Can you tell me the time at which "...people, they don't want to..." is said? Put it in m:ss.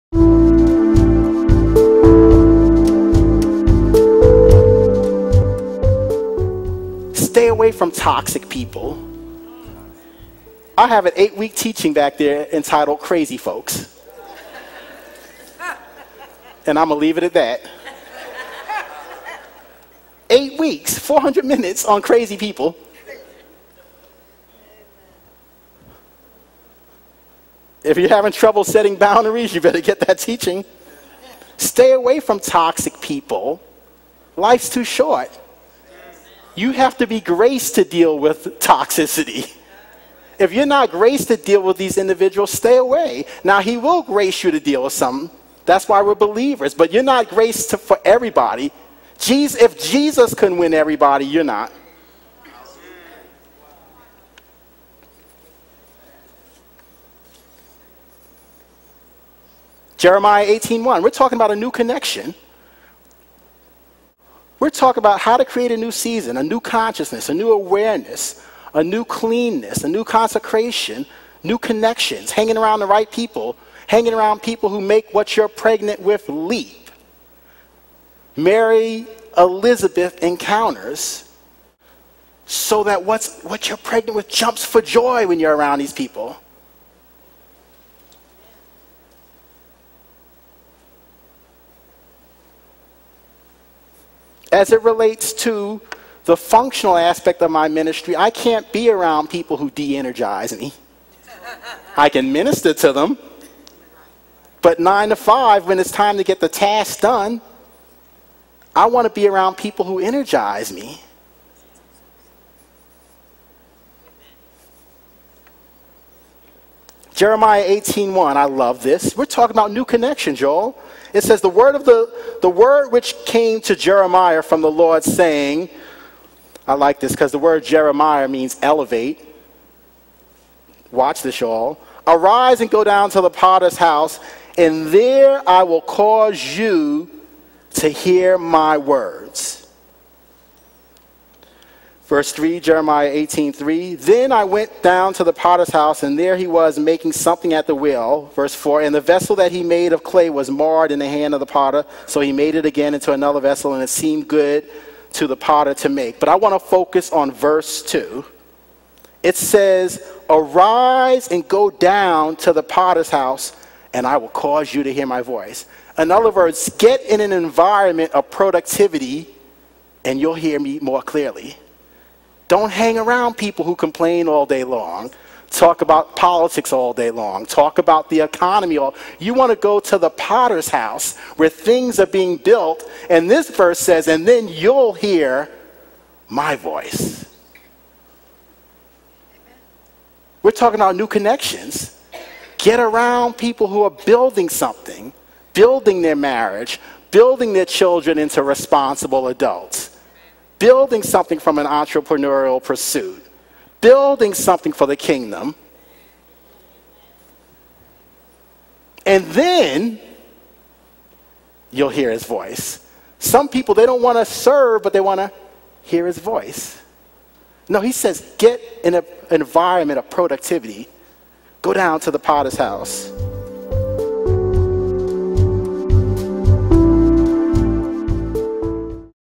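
3:33.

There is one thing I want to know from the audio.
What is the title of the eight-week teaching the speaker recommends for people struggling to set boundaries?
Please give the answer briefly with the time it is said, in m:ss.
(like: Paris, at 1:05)
Crazy Folks, at 0:12.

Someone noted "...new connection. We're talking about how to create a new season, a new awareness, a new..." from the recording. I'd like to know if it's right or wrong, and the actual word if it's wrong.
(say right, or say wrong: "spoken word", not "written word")
wrong: "consciousness", not "awareness".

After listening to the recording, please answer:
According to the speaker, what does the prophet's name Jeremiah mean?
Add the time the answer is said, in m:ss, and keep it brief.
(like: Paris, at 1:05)
Elevate, at 2:08.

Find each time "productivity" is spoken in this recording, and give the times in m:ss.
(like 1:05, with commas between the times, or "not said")
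2:48, 3:40.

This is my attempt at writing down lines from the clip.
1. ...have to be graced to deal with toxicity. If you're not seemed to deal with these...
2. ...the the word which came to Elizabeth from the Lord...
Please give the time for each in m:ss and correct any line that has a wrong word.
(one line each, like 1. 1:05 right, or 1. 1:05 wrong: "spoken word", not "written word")
1. 0:36 wrong: "graced", not "seemed"
2. 2:01 wrong: "Jeremiah", not "Elizabeth".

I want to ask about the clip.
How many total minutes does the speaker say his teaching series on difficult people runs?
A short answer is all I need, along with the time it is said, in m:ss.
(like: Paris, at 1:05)
400, at 0:20.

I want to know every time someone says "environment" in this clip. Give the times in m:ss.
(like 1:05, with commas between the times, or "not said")
2:47, 3:39.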